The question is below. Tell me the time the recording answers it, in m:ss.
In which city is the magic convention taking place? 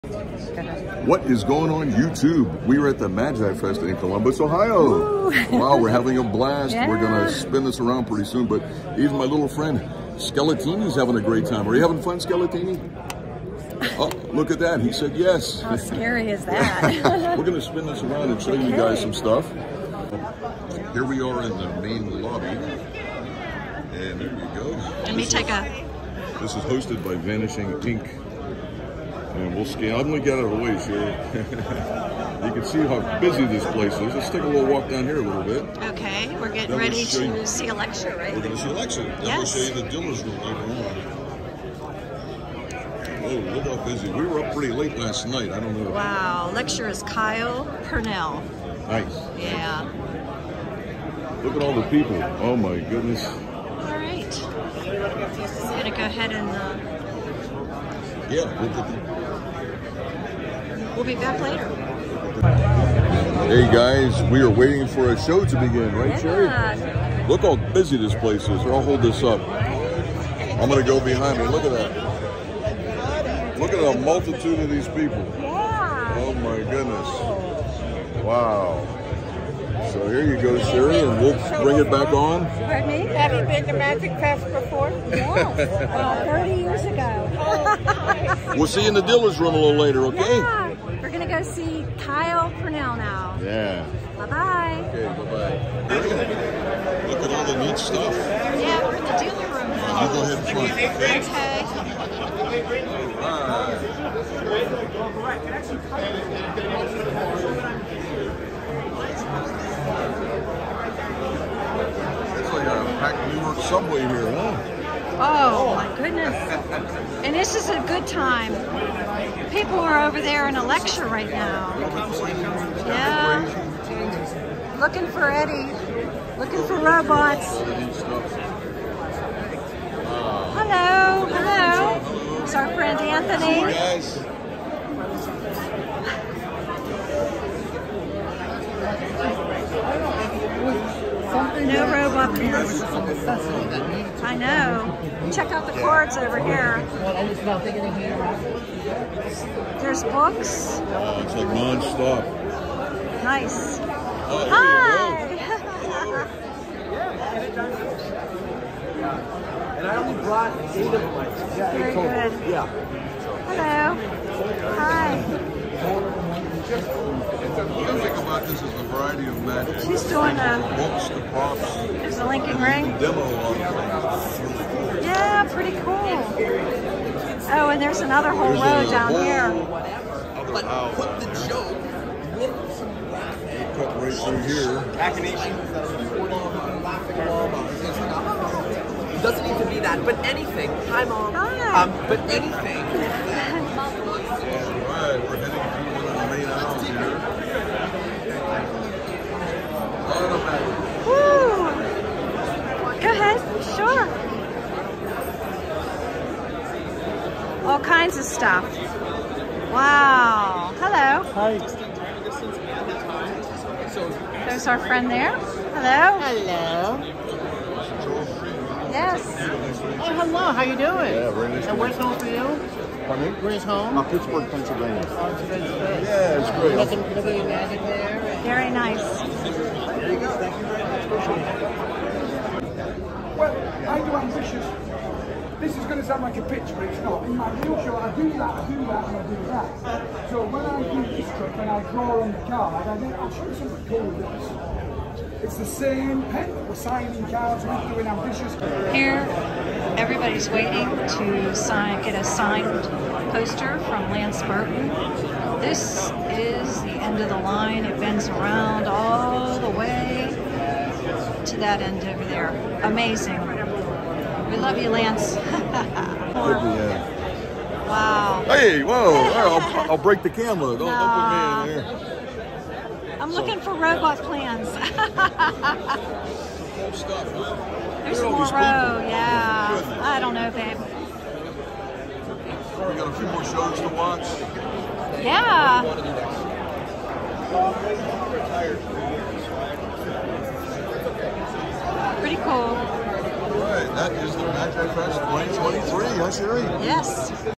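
0:03.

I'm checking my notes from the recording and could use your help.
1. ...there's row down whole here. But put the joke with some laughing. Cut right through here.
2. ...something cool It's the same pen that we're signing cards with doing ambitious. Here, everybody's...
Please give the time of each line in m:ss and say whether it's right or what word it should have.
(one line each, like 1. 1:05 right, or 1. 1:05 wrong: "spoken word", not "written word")
1. 2:58 right
2. 4:03 right.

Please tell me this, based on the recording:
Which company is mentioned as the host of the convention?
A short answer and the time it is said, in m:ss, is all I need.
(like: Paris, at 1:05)
Vanishing Ink, at 0:27.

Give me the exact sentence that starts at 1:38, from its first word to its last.
Yeah, we're in the dealer room now.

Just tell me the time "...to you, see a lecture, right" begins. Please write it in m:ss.
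0:37.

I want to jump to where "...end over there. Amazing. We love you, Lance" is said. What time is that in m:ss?
4:21.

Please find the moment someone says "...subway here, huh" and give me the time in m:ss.
1:53.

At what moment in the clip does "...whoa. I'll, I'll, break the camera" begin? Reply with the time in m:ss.
4:28.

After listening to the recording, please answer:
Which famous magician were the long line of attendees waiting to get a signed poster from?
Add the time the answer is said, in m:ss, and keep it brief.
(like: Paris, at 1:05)
Lance Burton, at 4:14.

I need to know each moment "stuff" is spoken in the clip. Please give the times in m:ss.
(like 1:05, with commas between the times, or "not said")
0:19, 1:37, 3:28, 4:34.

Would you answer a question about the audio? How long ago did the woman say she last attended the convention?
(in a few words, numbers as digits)
30 years ago.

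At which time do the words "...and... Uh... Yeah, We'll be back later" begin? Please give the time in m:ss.
0:56.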